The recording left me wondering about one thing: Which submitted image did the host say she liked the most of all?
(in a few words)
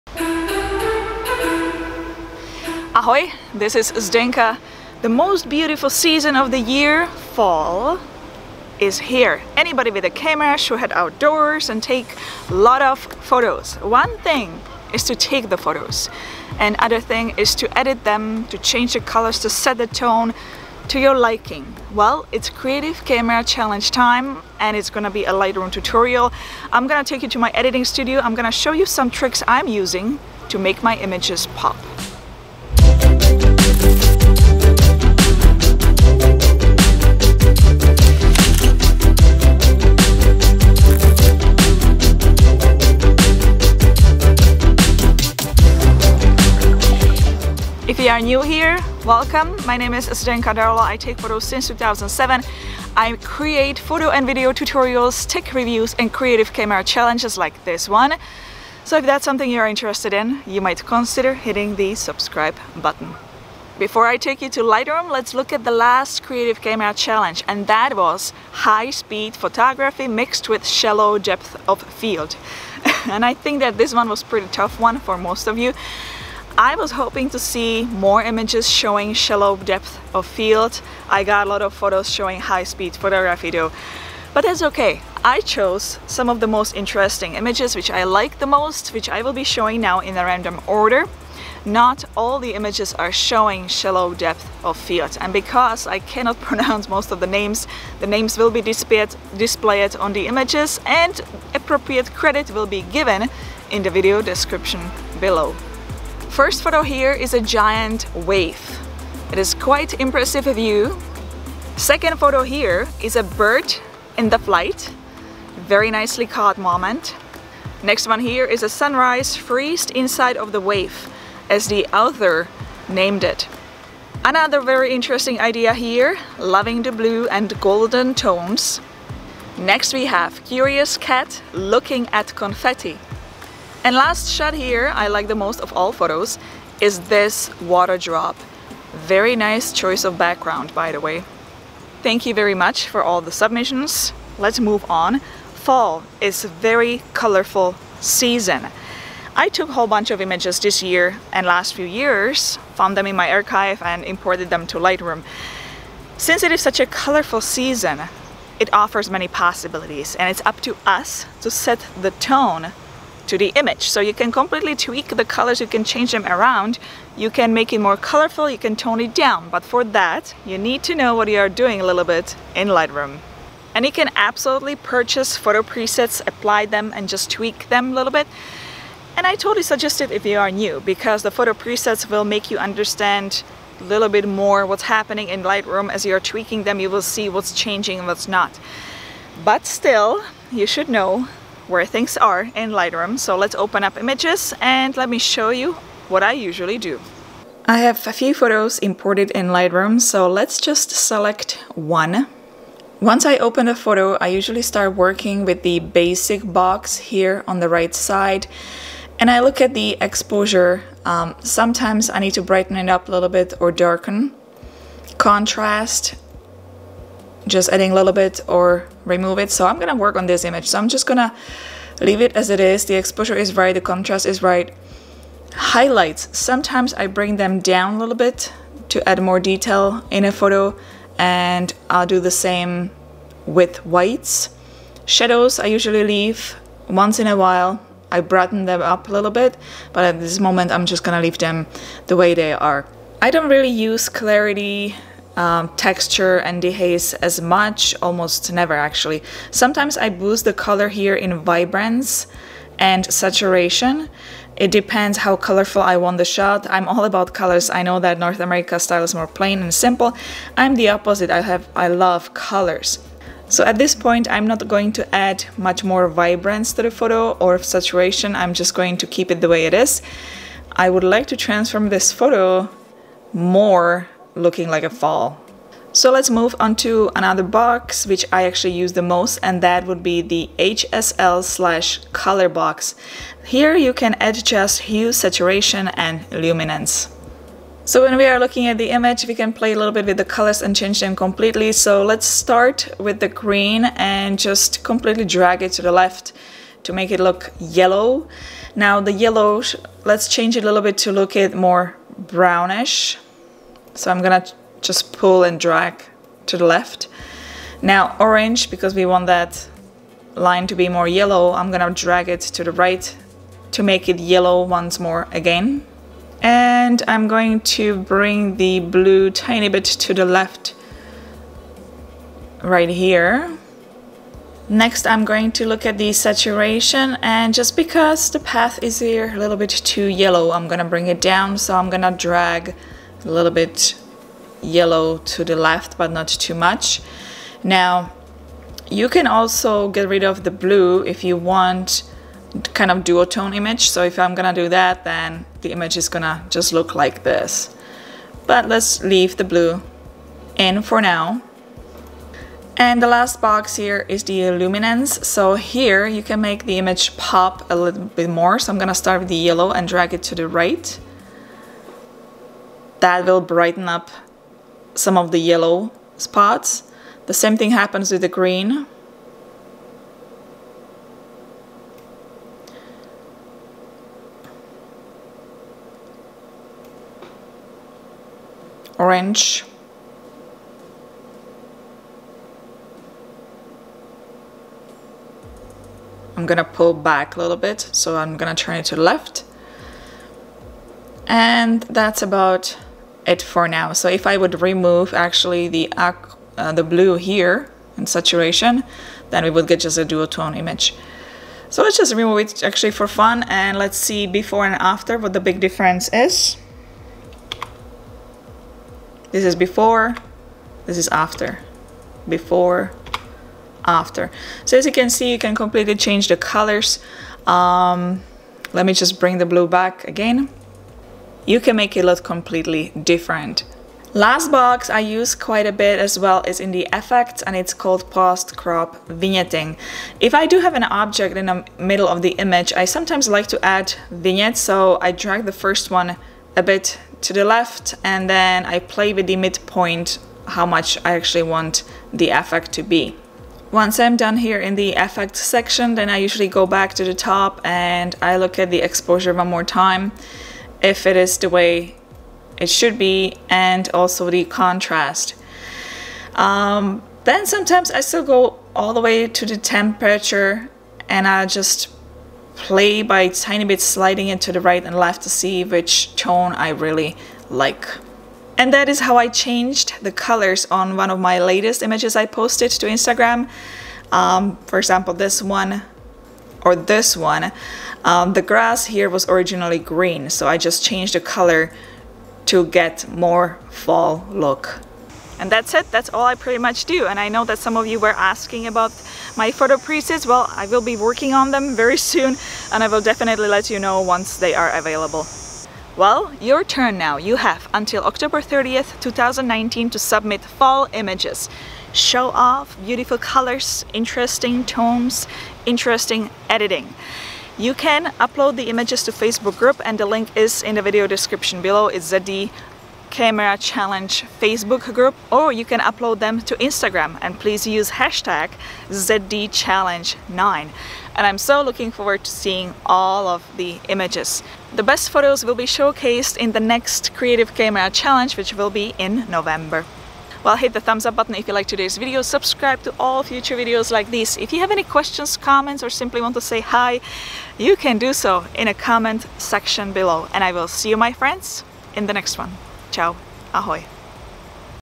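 Water drop.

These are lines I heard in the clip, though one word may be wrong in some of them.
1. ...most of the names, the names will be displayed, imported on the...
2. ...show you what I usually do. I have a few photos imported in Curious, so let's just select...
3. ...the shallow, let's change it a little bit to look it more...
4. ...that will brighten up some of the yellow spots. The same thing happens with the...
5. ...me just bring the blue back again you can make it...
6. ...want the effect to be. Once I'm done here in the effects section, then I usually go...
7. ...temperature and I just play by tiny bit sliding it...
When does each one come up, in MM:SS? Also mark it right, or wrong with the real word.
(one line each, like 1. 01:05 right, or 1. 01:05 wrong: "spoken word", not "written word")
1. 01:36 wrong: "displayed", not "imported"
2. 03:15 wrong: "Lightroom", not "Curious"
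3. 04:59 wrong: "yellow", not "shallow"
4. 06:03 right
5. 06:58 right
6. 07:21 right
7. 07:39 right.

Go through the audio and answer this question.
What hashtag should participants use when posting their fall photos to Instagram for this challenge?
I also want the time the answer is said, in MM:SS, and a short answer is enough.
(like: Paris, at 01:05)
ZDChallenge9, at 08:38.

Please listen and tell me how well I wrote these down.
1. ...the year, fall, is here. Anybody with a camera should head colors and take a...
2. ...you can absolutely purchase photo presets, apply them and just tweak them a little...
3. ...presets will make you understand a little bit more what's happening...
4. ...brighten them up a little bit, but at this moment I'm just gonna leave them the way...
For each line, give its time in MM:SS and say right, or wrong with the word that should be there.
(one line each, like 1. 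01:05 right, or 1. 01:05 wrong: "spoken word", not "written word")
1. 00:06 wrong: "outdoors", not "colors"
2. 02:53 right
3. 03:01 right
4. 03:58 right.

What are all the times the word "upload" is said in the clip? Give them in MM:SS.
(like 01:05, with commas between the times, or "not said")
08:28, 08:35.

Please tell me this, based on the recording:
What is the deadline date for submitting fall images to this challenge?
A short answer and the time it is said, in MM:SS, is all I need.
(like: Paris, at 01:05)
October 30th, 2019, at 08:18.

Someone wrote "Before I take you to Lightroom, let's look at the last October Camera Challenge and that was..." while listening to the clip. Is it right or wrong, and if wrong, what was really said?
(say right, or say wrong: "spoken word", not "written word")
wrong: "Creative", not "October".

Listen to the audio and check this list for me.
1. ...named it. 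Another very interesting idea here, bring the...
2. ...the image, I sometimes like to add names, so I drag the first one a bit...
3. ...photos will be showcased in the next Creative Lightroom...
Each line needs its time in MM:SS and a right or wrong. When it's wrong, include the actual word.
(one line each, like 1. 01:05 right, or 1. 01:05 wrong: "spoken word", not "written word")
1. 02:02 wrong: "loving", not "bring"
2. 07:12 wrong: "vignettes", not "names"
3. 08:45 wrong: "Camera", not "Lightroom".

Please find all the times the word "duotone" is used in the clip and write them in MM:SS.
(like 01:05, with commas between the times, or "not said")
05:43, 06:40.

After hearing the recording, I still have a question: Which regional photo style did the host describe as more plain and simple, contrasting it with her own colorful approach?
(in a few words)
North America.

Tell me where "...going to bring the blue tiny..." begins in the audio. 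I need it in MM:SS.
05:17.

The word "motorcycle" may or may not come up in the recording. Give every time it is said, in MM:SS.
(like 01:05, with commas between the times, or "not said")
not said.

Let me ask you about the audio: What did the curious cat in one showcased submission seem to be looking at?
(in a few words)
Confetti.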